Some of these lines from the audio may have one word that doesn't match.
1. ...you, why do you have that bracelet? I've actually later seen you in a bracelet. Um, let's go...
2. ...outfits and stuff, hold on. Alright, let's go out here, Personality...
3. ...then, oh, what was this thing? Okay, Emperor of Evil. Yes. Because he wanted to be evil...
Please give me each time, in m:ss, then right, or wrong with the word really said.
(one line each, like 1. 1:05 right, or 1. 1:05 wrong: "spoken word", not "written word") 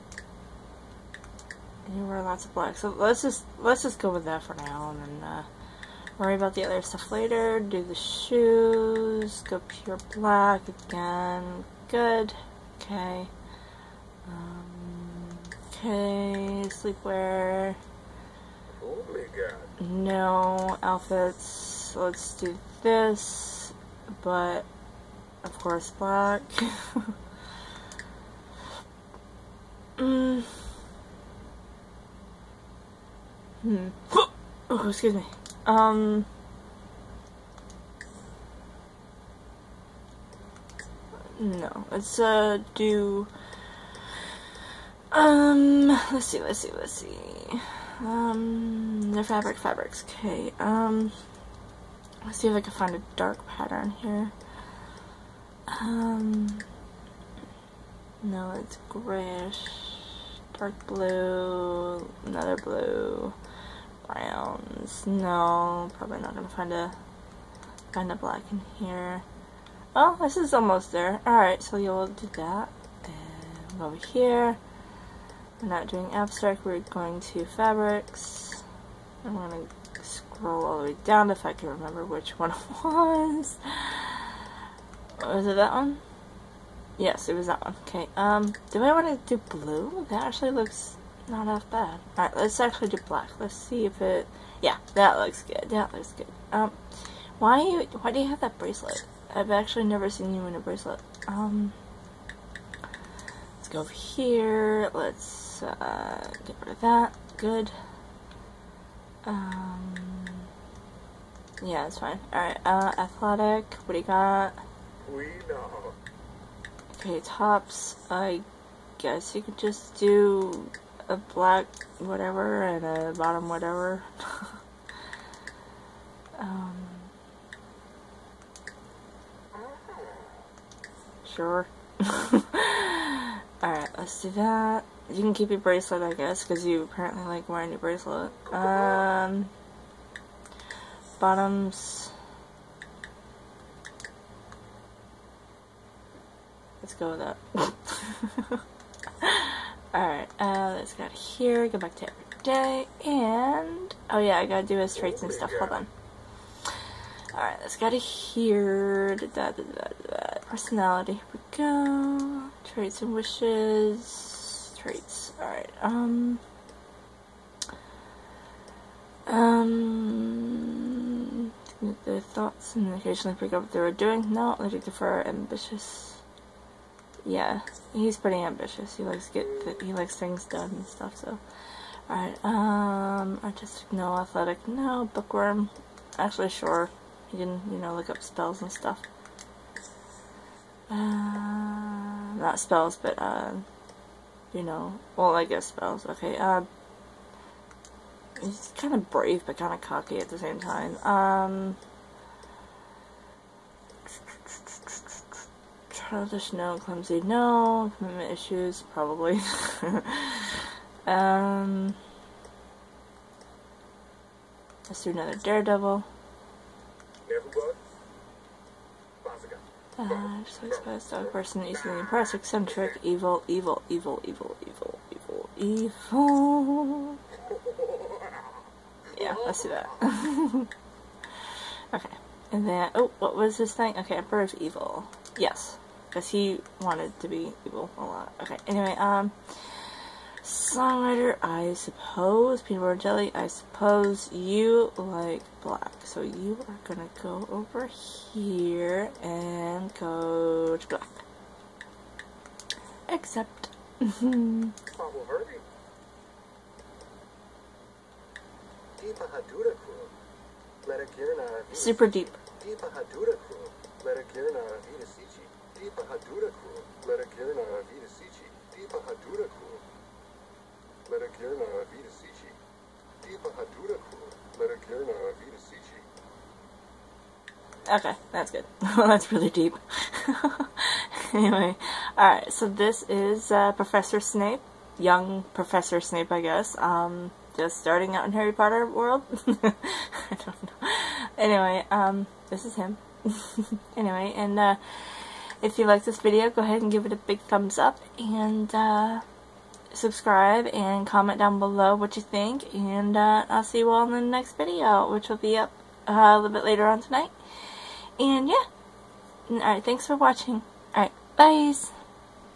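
1. 1:37 wrong: "never", not "later"
2. 2:34 wrong: "traits", not "outfits"
3. 3:52 right.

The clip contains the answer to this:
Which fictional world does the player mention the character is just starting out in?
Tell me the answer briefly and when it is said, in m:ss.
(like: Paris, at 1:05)
Harry Potter world, at 4:48.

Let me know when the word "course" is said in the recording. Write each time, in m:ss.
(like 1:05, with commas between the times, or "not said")
0:25.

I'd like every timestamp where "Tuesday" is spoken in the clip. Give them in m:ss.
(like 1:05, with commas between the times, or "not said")
not said.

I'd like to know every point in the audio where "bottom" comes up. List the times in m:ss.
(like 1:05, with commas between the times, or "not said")
2:03, 2:21.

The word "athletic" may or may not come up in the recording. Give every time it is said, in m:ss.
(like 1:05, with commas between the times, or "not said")
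1:52, 3:04.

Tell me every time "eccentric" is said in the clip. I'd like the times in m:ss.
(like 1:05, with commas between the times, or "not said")
3:42.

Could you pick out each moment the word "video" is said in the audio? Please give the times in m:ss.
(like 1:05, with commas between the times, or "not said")
4:56, 5:04.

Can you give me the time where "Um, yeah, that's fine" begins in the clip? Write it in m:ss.
1:49.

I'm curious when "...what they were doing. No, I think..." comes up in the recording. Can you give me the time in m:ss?
2:53.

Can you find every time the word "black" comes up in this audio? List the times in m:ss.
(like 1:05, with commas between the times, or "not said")
0:02, 0:10, 0:25, 1:08, 1:33, 2:01, 4:05, 4:10.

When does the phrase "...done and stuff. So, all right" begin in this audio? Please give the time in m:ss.
3:00.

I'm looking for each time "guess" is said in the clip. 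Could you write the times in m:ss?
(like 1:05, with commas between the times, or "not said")
1:58, 2:16, 3:15.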